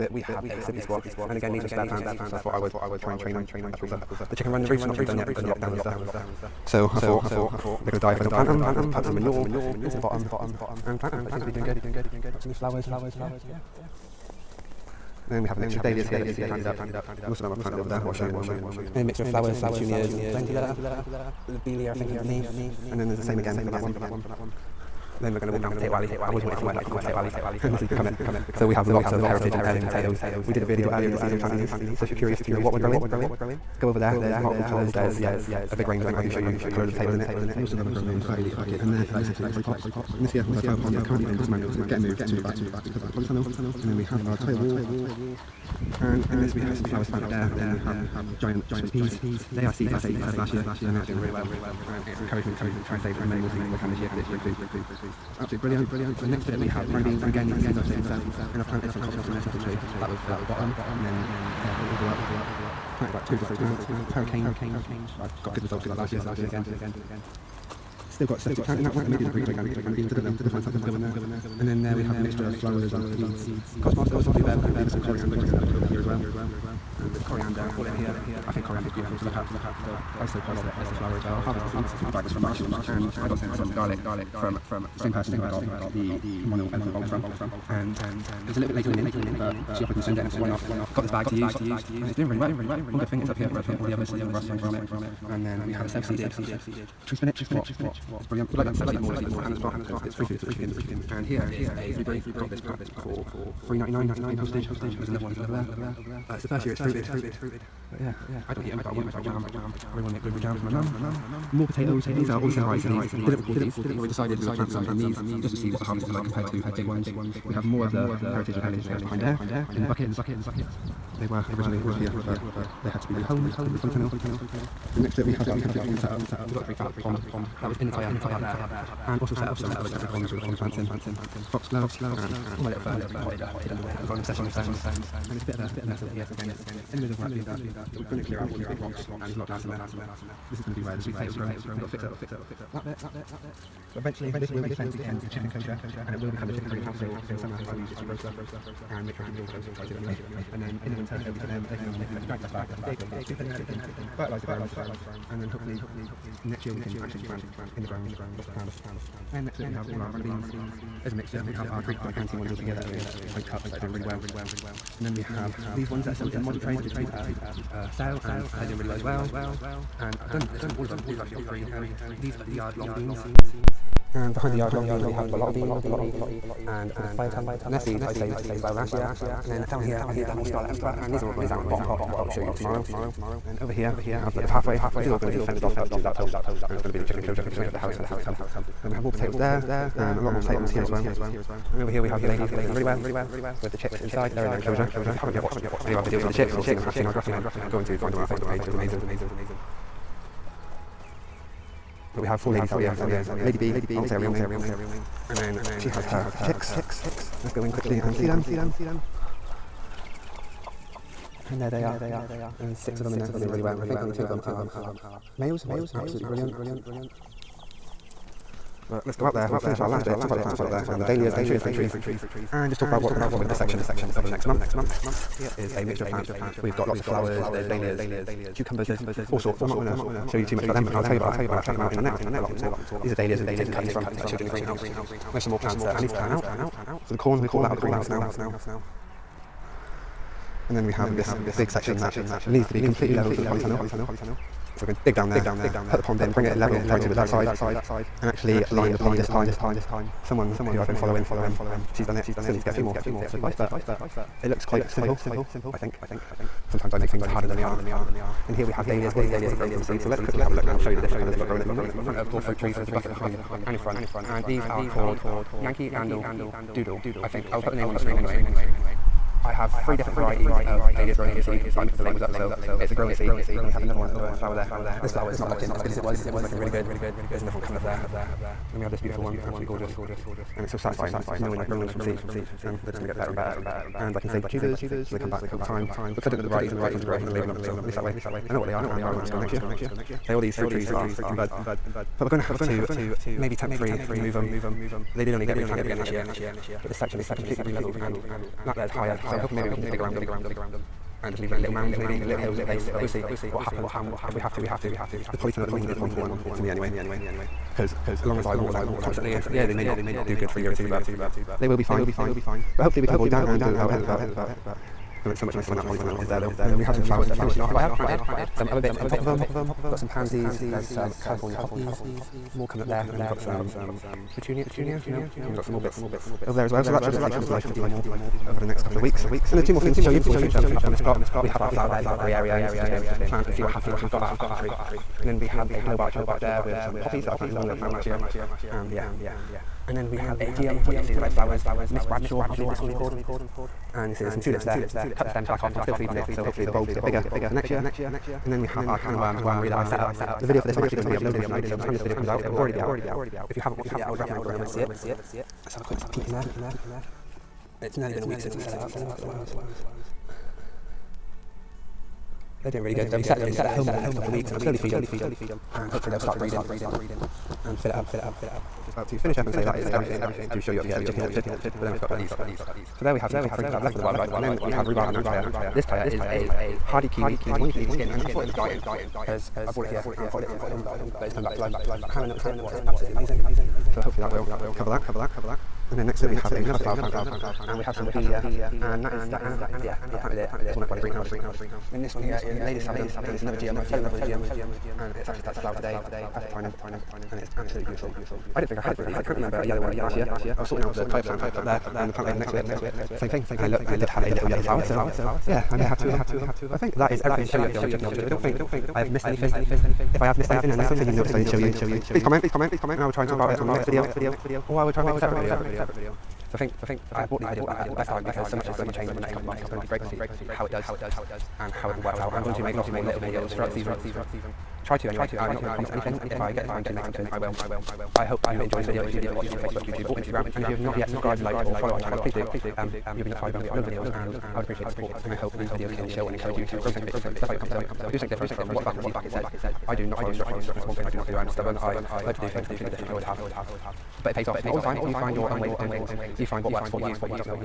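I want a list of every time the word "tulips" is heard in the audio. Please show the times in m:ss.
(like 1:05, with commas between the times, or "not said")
5:44.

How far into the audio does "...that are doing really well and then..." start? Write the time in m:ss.
2:43.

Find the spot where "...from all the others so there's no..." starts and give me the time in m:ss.
1:33.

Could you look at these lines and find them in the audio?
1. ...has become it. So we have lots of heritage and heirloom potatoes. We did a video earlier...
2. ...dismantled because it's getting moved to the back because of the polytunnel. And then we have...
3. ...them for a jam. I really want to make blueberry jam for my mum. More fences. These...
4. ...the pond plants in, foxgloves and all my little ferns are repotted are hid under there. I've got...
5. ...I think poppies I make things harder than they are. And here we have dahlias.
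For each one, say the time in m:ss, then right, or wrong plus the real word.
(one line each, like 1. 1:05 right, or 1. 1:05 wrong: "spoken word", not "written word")
1. 0:27 right
2. 0:41 right
3. 1:49 wrong: "potatoes", not "fences"
4. 2:10 right
5. 4:15 wrong: "sometimes", not "poppies".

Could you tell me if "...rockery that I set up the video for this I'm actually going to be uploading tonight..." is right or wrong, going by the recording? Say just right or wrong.
wrong.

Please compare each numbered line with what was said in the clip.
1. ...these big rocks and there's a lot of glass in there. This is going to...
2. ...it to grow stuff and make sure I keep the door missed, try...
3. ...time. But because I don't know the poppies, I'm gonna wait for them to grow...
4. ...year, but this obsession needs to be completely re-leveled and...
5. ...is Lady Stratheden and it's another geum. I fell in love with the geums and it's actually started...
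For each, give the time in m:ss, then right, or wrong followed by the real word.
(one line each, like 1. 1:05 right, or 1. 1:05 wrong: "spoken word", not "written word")
1. 2:18 right
2. 2:27 wrong: "closed", not "missed"
3. 4:45 wrong: "varieties", not "poppies"
4. 4:56 wrong: "section", not "obsession"
5. 6:32 right.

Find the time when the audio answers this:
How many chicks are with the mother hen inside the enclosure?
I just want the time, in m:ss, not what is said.
3:32.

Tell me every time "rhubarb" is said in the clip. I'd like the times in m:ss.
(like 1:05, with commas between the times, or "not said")
6:14.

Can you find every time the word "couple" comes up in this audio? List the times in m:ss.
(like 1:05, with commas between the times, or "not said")
5:28, 6:04, 6:59.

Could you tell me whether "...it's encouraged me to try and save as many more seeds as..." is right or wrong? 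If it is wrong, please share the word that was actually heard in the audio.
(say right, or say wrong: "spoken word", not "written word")
right.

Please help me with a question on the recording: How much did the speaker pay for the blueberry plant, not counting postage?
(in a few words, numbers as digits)
3.99.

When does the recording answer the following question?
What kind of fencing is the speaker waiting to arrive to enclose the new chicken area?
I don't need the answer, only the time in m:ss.
3:07.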